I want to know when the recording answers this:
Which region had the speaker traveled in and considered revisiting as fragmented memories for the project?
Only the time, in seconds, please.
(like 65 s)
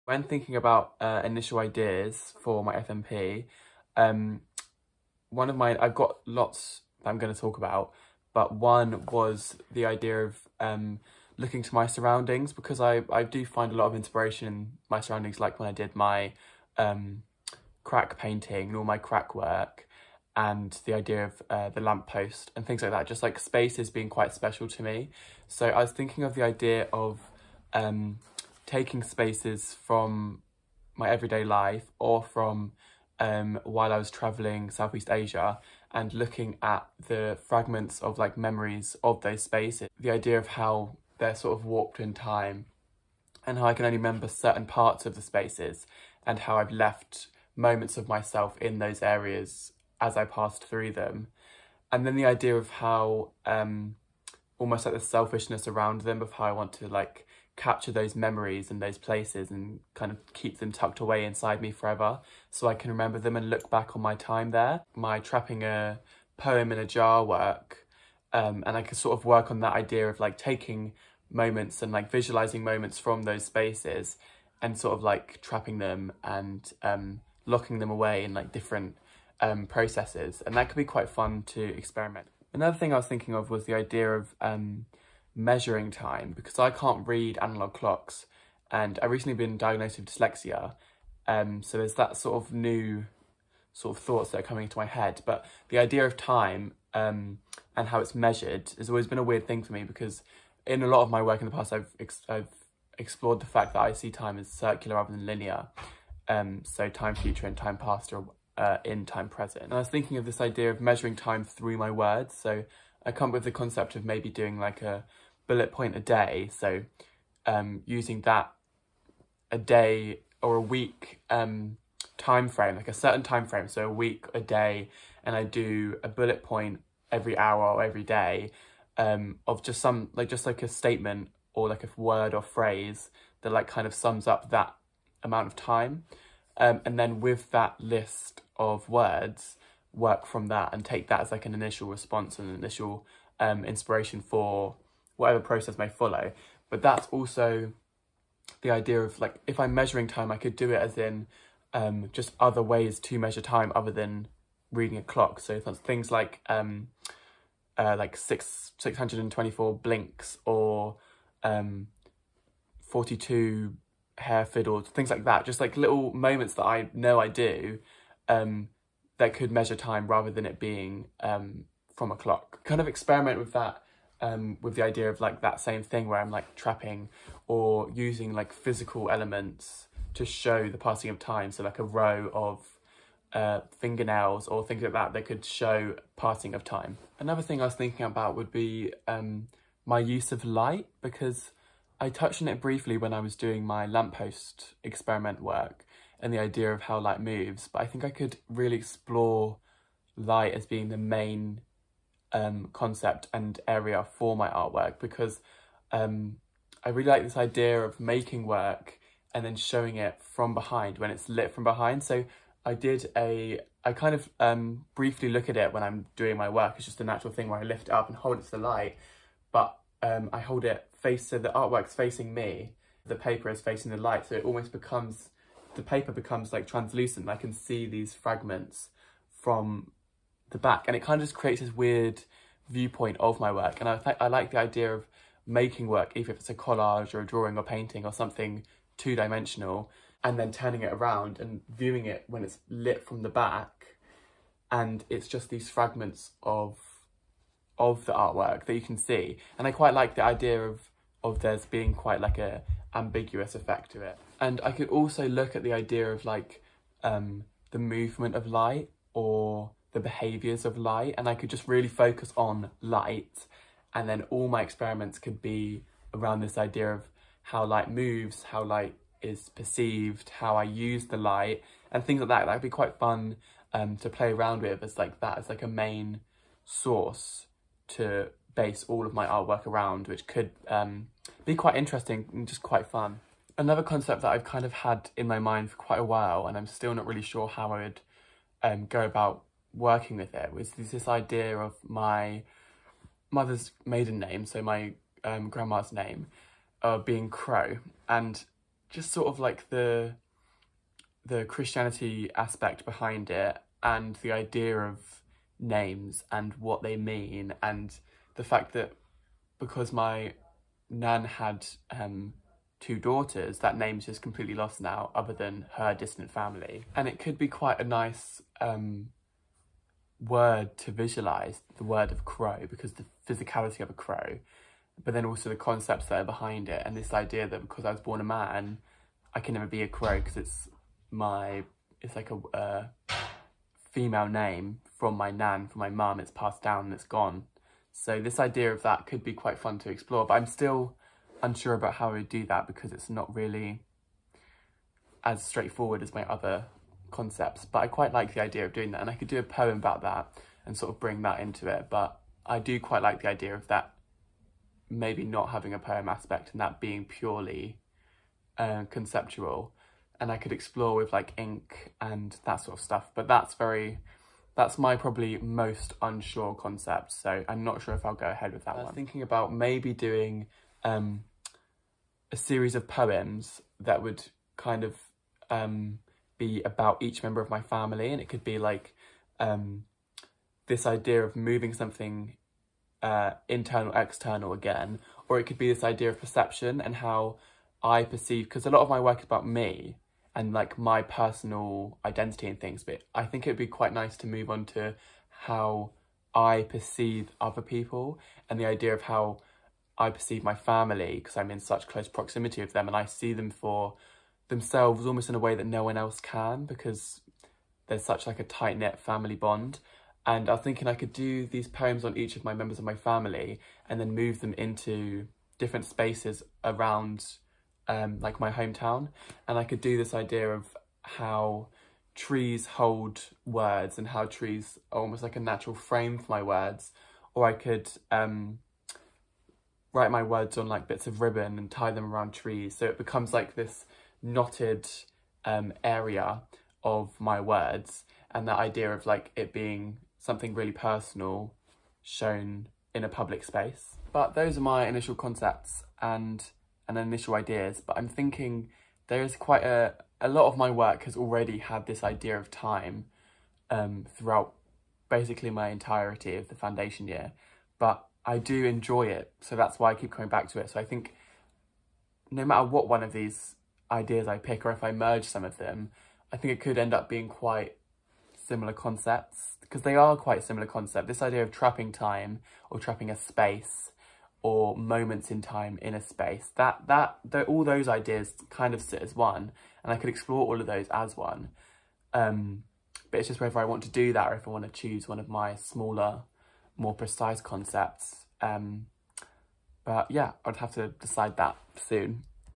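34 s.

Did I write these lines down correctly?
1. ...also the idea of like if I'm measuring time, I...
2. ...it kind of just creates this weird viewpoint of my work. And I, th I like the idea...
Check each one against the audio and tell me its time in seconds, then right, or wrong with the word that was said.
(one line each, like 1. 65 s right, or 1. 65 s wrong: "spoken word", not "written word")
1. 147 s right
2. 230 s right.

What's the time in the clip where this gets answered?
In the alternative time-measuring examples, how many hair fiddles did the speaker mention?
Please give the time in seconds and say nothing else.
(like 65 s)
162 s.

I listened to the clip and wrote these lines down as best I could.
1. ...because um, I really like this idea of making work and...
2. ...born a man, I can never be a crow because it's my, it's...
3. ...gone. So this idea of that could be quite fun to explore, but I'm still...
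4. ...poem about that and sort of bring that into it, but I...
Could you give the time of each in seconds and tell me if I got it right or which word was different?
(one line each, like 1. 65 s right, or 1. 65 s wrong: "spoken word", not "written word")
1. 204 s right
2. 328 s right
3. 337 s right
4. 349 s right.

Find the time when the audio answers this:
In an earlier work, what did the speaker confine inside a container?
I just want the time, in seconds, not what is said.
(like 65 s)
65 s.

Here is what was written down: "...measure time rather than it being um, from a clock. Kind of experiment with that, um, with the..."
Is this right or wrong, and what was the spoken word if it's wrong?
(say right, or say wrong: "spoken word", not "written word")
right.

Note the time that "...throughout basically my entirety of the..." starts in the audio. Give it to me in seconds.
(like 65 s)
454 s.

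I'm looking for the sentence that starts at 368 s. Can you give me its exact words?
Thinking about maybe doing um, a series of poems that would kind of um, be about each member of my family.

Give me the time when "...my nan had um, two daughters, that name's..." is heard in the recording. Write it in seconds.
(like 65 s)
309 s.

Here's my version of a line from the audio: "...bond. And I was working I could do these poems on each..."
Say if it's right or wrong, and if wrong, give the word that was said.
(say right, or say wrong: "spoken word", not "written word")
wrong: "thinking", not "working".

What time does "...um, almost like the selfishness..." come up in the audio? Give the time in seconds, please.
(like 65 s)
53 s.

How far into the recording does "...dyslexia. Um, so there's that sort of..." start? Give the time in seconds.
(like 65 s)
90 s.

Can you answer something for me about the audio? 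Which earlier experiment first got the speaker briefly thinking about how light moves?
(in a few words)
Lamppost experiment.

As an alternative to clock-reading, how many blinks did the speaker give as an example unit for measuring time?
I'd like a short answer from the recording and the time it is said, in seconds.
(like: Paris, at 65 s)
624, at 158 s.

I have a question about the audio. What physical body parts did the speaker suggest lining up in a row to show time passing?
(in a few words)
Fingernails.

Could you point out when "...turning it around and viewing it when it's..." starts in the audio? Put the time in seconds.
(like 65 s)
240 s.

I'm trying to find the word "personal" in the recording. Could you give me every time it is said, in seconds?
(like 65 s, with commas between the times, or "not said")
391 s, 440 s.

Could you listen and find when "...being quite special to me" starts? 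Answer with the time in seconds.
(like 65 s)
23 s.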